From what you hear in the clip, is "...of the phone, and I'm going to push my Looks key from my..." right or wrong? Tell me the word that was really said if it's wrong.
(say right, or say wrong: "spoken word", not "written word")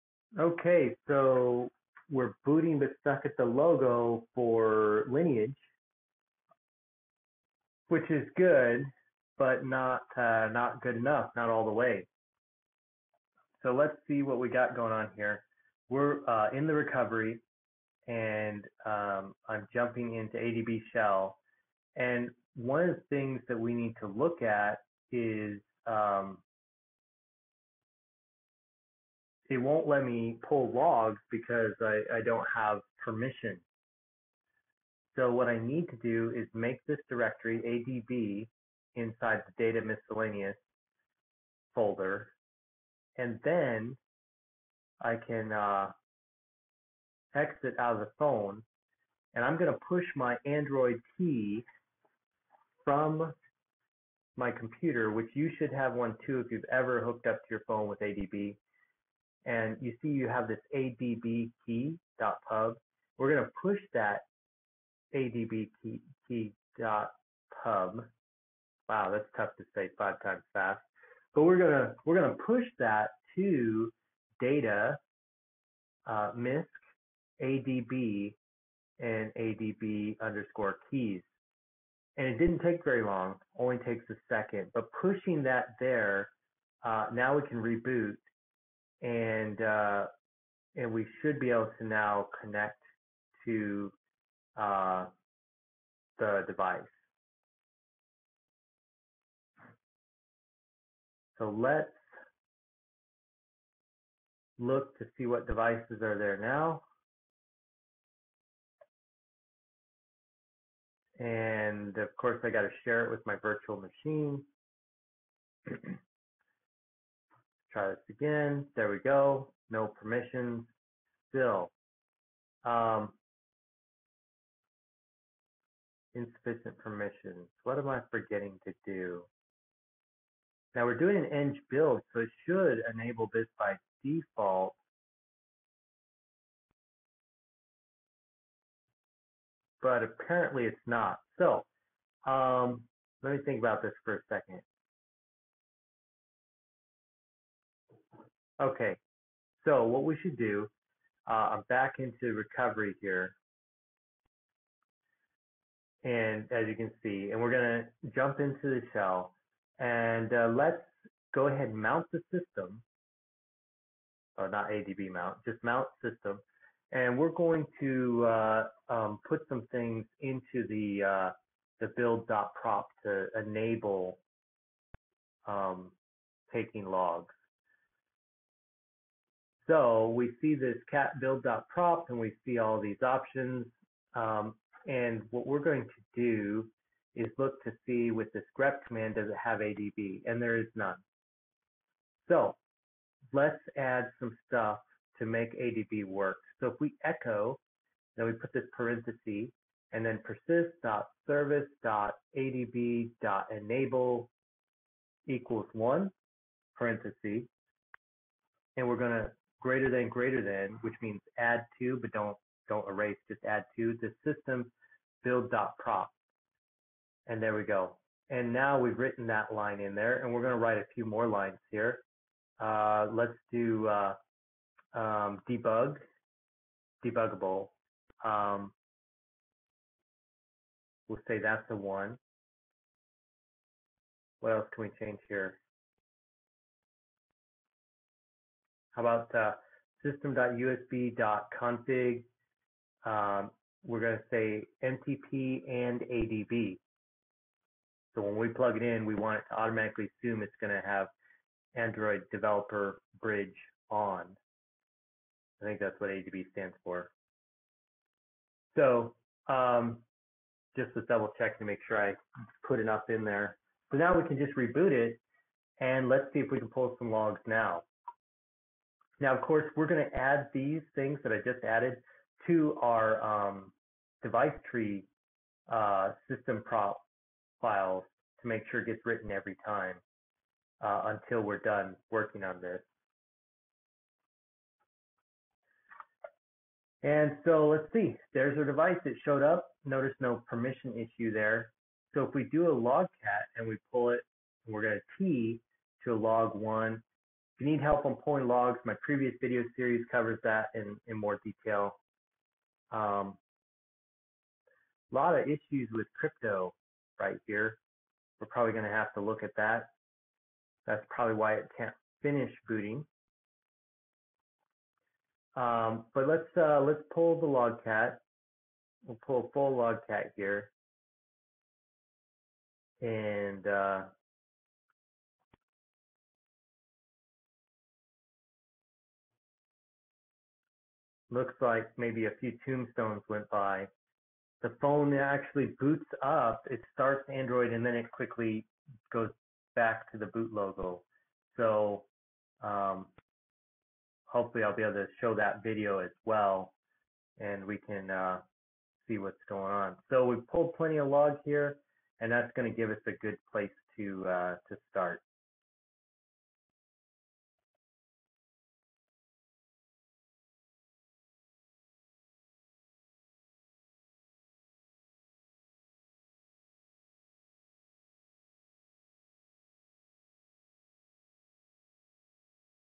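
wrong: "Android", not "Looks".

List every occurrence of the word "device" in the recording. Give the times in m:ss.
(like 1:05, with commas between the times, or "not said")
1:36, 1:45, 4:34, 4:48.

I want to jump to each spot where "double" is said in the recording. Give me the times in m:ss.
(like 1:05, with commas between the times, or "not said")
4:21.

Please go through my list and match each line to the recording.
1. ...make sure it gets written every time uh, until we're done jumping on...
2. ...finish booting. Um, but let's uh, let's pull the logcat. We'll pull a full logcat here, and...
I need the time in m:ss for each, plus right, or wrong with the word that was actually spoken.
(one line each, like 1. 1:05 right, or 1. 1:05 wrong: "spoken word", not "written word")
1. 4:38 wrong: "working", not "jumping"
2. 5:12 right.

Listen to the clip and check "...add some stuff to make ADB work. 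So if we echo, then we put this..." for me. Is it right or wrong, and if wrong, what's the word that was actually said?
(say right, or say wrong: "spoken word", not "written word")
right.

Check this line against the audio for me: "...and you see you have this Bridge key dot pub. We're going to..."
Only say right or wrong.
wrong.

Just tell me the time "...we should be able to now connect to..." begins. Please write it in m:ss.
1:30.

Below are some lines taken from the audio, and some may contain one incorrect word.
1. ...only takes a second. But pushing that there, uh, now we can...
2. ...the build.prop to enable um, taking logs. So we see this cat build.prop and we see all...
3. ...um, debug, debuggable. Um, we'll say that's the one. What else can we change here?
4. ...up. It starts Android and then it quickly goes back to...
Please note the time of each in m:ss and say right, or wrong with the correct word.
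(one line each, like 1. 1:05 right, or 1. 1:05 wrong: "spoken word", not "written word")
1. 1:23 right
2. 2:51 right
3. 3:44 right
4. 5:36 right.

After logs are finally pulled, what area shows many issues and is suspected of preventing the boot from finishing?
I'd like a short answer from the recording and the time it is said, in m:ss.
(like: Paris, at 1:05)
crypto, at 5:06.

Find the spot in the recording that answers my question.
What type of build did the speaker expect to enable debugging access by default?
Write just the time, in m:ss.
2:11.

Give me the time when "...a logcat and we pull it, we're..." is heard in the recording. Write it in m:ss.
4:52.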